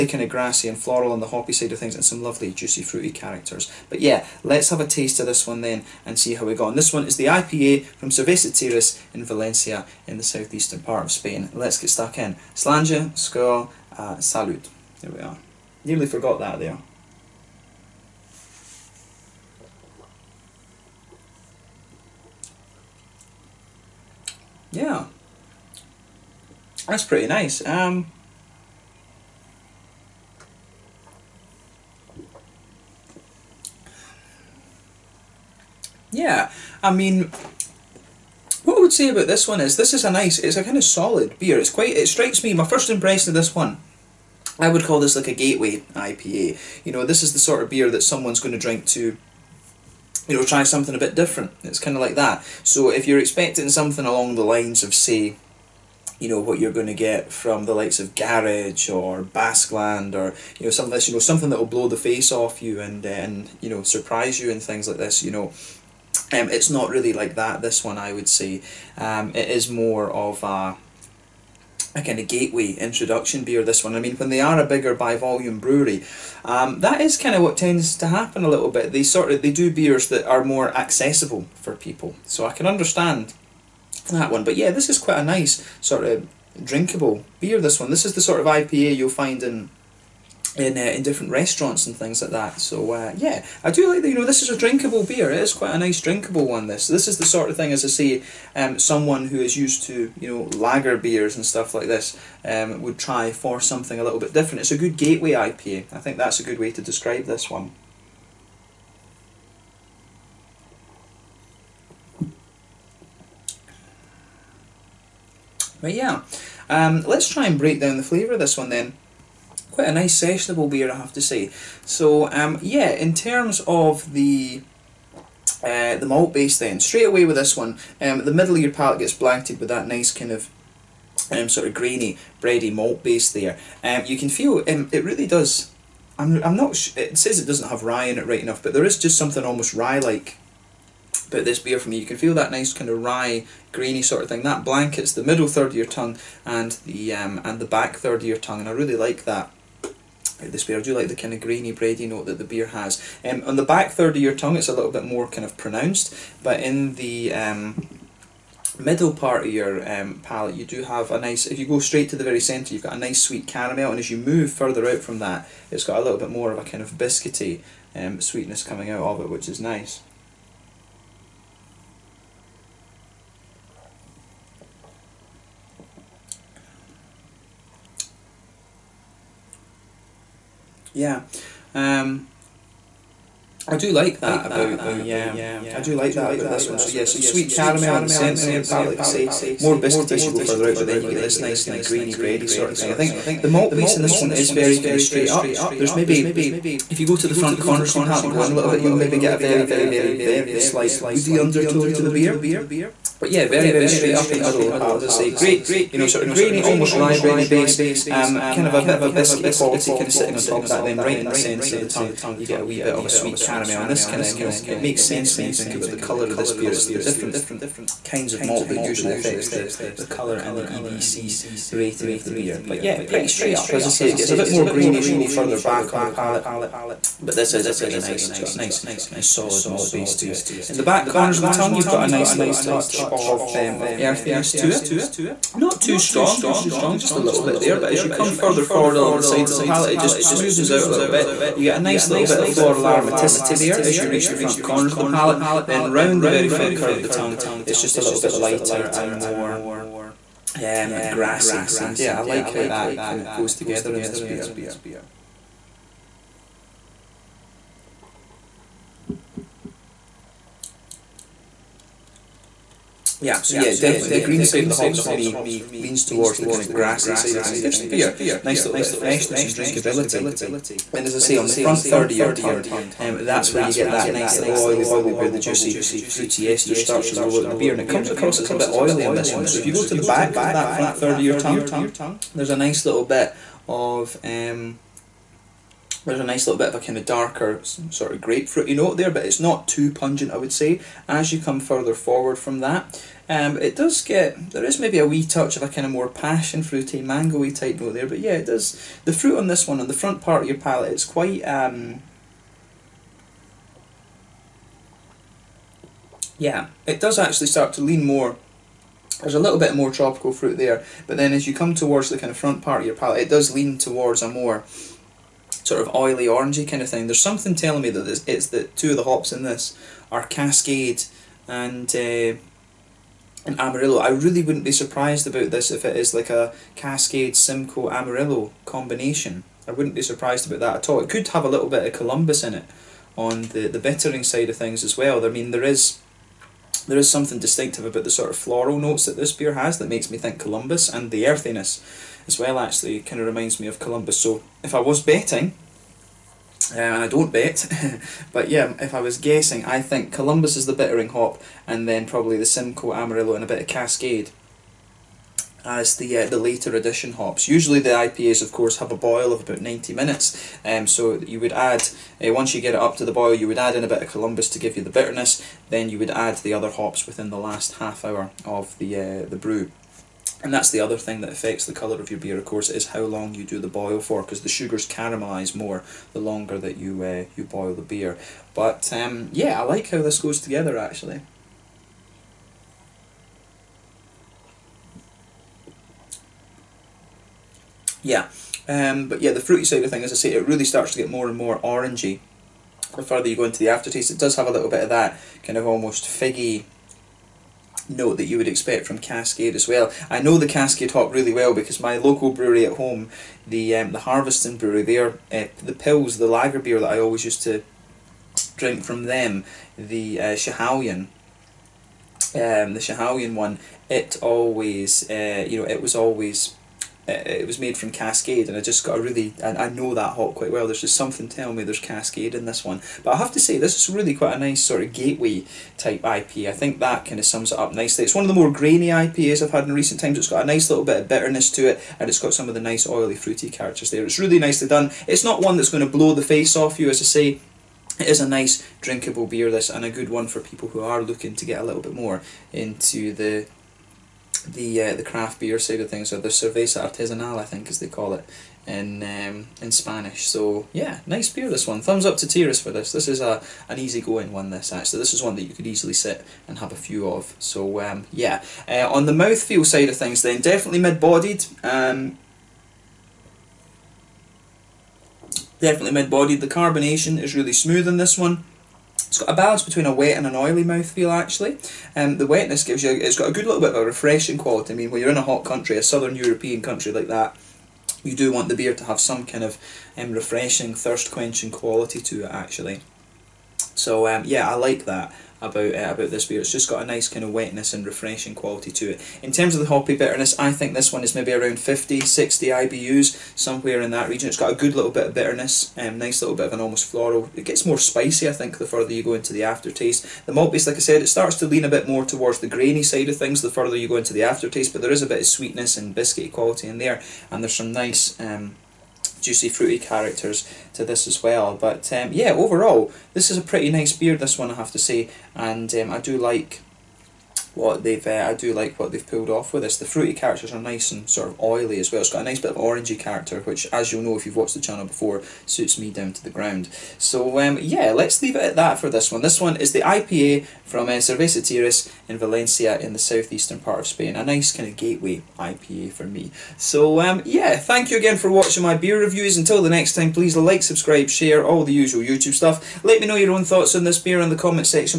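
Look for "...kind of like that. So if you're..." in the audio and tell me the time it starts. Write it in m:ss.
0:51.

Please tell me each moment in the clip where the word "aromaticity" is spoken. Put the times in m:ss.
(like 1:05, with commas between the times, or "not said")
4:02.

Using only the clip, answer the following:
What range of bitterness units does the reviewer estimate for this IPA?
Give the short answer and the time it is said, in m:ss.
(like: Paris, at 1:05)
50-60 IBUs, at 8:11.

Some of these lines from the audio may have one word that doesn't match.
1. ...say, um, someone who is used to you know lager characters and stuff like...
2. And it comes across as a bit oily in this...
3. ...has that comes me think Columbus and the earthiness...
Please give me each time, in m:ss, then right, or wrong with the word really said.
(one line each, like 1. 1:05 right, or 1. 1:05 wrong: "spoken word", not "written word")
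1. 1:37 wrong: "beers", not "characters"
2. 4:37 right
3. 5:39 wrong: "makes", not "comes".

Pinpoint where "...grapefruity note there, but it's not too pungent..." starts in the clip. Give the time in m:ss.
4:48.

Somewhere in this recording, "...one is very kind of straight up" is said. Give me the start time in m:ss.
3:14.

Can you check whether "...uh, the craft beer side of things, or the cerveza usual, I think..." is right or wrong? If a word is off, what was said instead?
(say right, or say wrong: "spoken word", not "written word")
wrong: "artesanal", not "usual".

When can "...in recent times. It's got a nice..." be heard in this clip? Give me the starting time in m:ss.
7:09.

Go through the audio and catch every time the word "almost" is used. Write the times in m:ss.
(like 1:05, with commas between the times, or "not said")
2:19, 3:26, 6:35, 8:16.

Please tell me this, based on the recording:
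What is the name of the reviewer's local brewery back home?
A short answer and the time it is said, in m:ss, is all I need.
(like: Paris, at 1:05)
Harviestoun Brewery, at 6:43.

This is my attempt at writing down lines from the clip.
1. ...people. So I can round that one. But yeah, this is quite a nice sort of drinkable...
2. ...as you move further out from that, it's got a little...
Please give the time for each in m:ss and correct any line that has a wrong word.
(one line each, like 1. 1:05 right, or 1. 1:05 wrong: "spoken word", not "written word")
1. 1:21 wrong: "understand", not "round"
2. 2:43 right.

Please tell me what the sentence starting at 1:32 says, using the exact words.
So uh, yeah, I do like that.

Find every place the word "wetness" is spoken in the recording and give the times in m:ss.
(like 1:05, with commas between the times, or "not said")
7:52, 8:07.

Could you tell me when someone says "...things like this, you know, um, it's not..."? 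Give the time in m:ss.
1:04.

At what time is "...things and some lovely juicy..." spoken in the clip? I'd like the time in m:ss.
0:01.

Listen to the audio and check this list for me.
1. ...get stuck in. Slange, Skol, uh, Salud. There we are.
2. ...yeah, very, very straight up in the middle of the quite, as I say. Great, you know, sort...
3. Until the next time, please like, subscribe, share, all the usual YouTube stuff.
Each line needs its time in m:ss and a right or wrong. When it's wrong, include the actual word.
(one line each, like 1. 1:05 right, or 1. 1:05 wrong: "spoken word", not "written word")
1. 0:11 right
2. 3:23 wrong: "palate", not "quite"
3. 8:59 right.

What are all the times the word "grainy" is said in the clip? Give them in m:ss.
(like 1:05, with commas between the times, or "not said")
2:11, 2:23, 2:31, 3:11, 3:26, 3:44, 7:08, 8:22.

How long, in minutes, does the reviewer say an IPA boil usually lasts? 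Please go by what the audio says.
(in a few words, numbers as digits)
90.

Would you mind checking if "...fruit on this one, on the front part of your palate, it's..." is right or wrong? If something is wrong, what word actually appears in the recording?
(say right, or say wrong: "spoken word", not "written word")
right.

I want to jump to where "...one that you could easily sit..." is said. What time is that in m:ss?
7:35.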